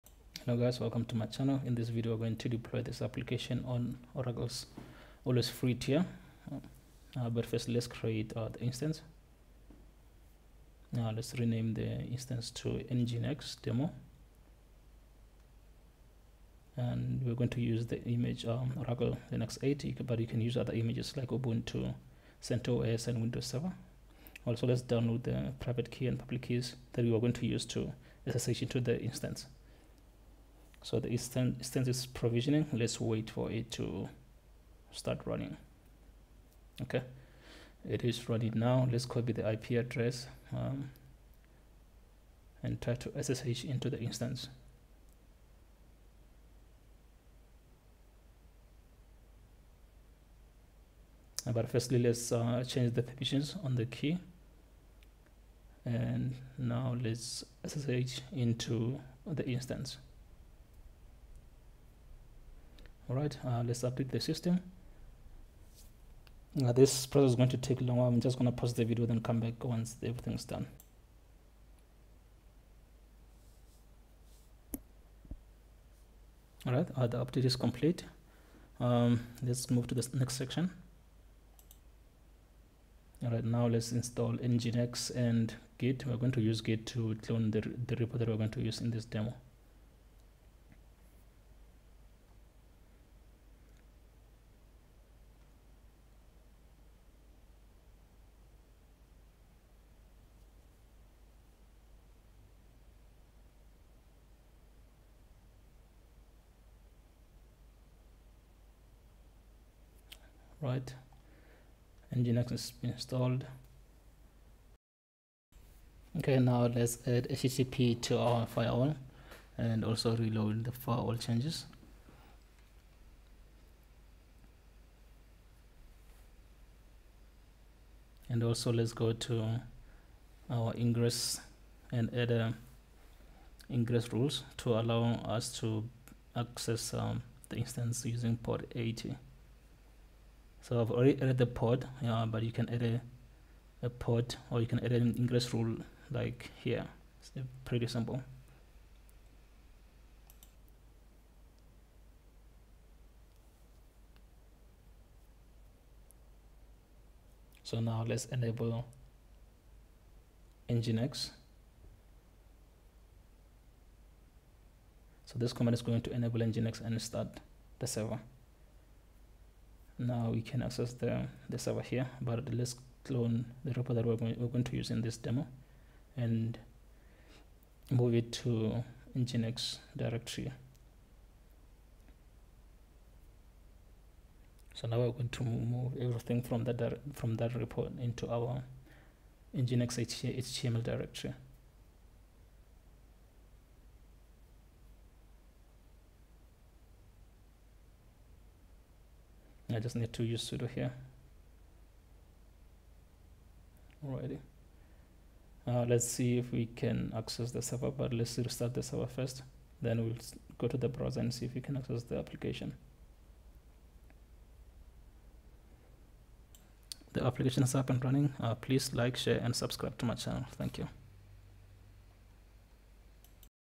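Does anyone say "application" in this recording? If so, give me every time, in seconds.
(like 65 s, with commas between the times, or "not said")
3 s, 212 s, 217 s.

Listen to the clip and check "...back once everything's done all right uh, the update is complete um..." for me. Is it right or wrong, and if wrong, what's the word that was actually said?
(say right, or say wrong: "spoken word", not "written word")
right.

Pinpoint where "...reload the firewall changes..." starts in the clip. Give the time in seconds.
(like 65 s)
120 s.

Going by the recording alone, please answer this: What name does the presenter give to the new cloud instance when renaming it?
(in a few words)
nginx demo.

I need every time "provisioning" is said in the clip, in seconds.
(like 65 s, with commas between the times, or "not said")
32 s.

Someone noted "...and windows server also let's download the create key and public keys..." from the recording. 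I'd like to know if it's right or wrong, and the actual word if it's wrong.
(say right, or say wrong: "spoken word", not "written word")
wrong: "private", not "create".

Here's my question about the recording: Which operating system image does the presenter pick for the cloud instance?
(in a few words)
Oracle Linux 8.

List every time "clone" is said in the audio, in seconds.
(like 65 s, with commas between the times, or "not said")
87 s, 173 s.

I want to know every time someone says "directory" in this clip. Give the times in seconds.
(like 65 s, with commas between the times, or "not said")
179 s, 190 s.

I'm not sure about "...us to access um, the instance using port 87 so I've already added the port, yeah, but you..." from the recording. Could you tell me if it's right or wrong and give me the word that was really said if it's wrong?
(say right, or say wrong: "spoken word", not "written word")
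wrong: "80", not "87".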